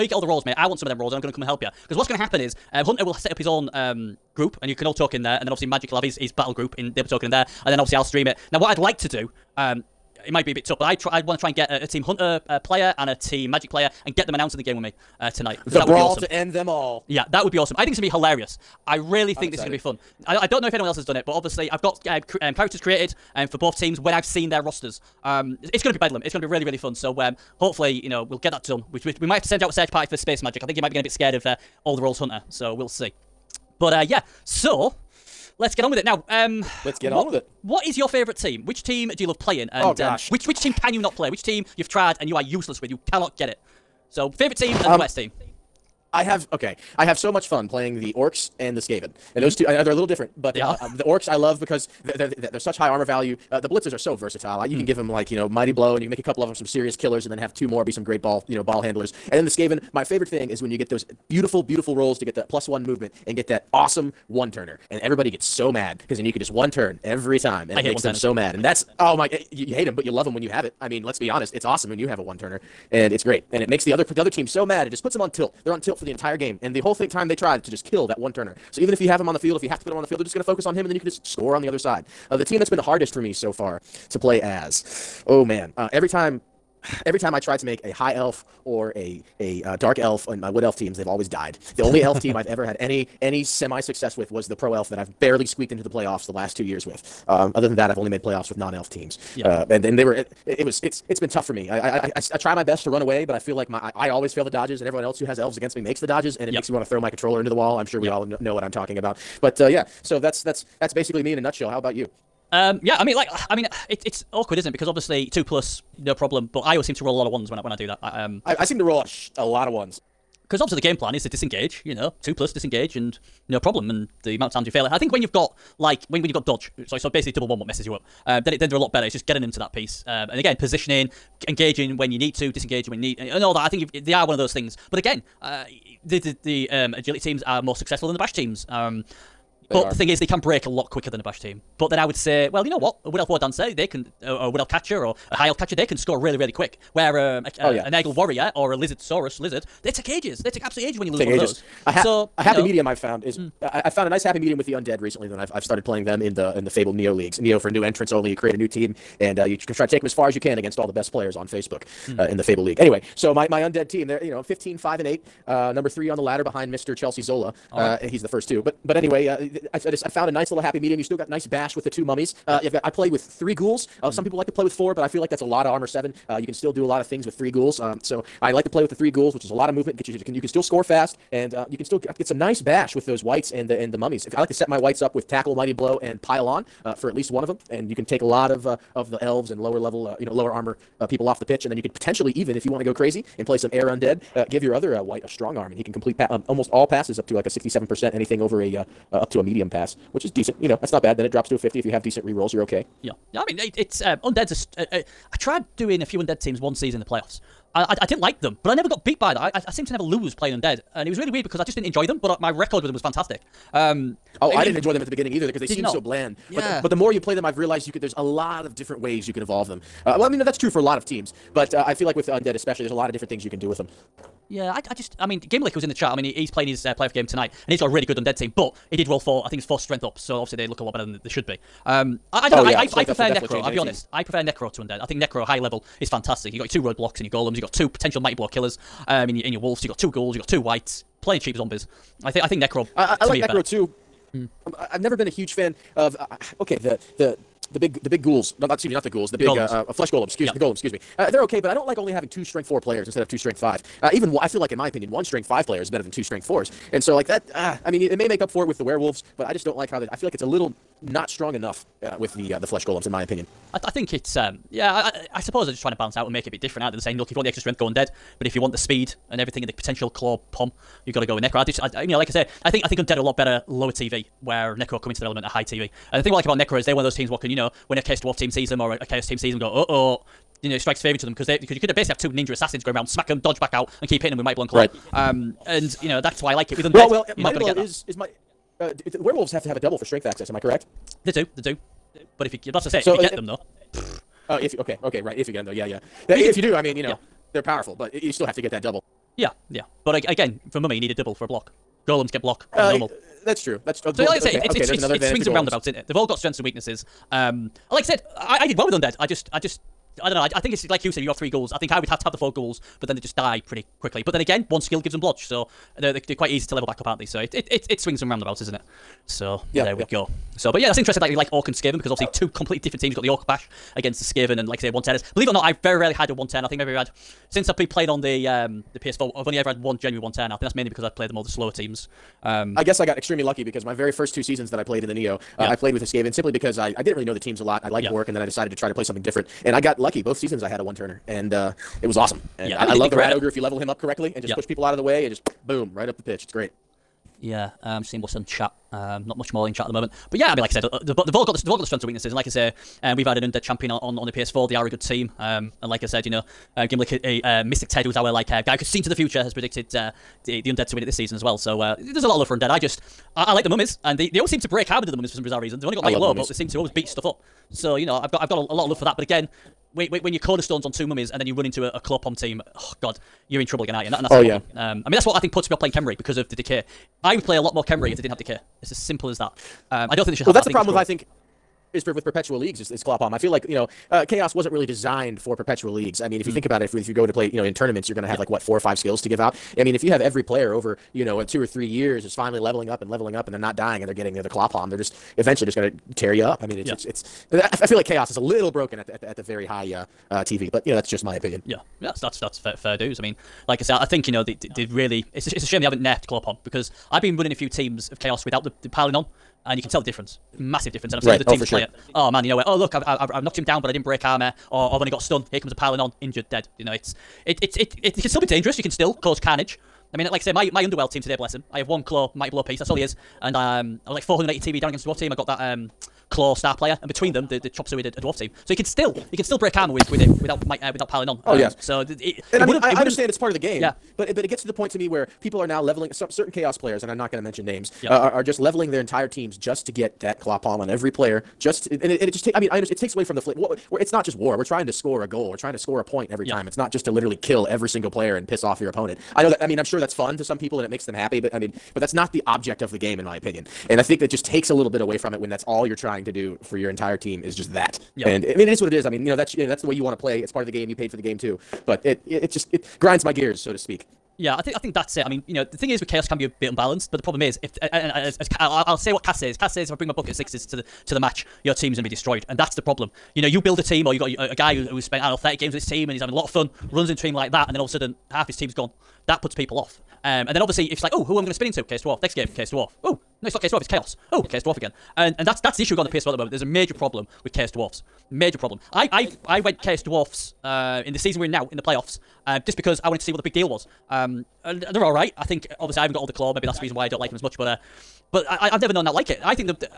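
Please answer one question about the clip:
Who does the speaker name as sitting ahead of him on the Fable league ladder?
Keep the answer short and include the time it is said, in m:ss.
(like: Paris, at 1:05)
Mr. Chelsea Zola, at 2:46.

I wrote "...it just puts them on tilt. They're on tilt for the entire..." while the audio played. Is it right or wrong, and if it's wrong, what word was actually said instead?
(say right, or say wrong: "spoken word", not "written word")
right.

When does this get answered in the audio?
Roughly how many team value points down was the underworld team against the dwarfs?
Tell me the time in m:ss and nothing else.
7:04.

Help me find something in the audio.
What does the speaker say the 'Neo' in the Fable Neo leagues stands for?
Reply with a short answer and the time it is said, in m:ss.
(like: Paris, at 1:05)
New entrants only, at 2:37.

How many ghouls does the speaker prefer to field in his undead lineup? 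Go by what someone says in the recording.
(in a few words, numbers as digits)
3.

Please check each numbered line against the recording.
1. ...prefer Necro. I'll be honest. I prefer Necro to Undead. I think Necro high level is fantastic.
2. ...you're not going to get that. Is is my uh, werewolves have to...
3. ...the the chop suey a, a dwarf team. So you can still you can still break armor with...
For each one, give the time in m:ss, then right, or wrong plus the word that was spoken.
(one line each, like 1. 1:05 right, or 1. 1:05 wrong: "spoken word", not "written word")
1. 3:53 right
2. 4:47 right
3. 7:07 right.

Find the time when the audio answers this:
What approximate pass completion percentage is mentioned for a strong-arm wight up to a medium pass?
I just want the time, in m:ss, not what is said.
3:17.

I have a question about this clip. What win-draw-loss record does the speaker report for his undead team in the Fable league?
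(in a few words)
15, 5 and 8.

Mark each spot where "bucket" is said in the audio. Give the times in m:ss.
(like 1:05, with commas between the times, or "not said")
7:50.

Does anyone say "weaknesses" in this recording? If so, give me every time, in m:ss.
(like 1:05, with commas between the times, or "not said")
5:06, 5:52.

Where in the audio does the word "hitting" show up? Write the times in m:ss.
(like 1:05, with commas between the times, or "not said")
4:44.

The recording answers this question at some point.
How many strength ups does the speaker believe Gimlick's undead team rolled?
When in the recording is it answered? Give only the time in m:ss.
3:49.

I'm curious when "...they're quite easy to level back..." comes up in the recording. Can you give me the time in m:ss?
5:16.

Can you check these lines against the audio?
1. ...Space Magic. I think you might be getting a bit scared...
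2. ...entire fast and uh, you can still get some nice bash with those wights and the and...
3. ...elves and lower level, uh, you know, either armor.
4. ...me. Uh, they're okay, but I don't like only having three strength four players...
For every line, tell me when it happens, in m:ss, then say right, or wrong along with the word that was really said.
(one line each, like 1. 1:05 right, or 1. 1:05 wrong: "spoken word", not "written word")
1. 0:30 right
2. 3:00 wrong: "score", not "entire"
3. 3:09 wrong: "lower", not "either"
4. 4:10 wrong: "two", not "three".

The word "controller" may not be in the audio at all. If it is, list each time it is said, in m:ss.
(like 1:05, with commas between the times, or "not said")
1:47.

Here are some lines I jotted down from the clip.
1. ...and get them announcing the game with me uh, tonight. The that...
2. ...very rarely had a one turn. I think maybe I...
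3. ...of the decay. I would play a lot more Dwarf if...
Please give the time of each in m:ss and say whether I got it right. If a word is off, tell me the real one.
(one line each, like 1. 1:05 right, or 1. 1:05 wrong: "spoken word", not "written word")
1. 0:14 right
2. 5:25 right
3. 6:16 wrong: "Khemri", not "Dwarf".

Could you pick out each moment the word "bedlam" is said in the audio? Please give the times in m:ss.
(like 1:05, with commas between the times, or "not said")
0:25.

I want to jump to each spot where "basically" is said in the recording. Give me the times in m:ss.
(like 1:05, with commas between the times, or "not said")
1:50, 2:07, 4:41.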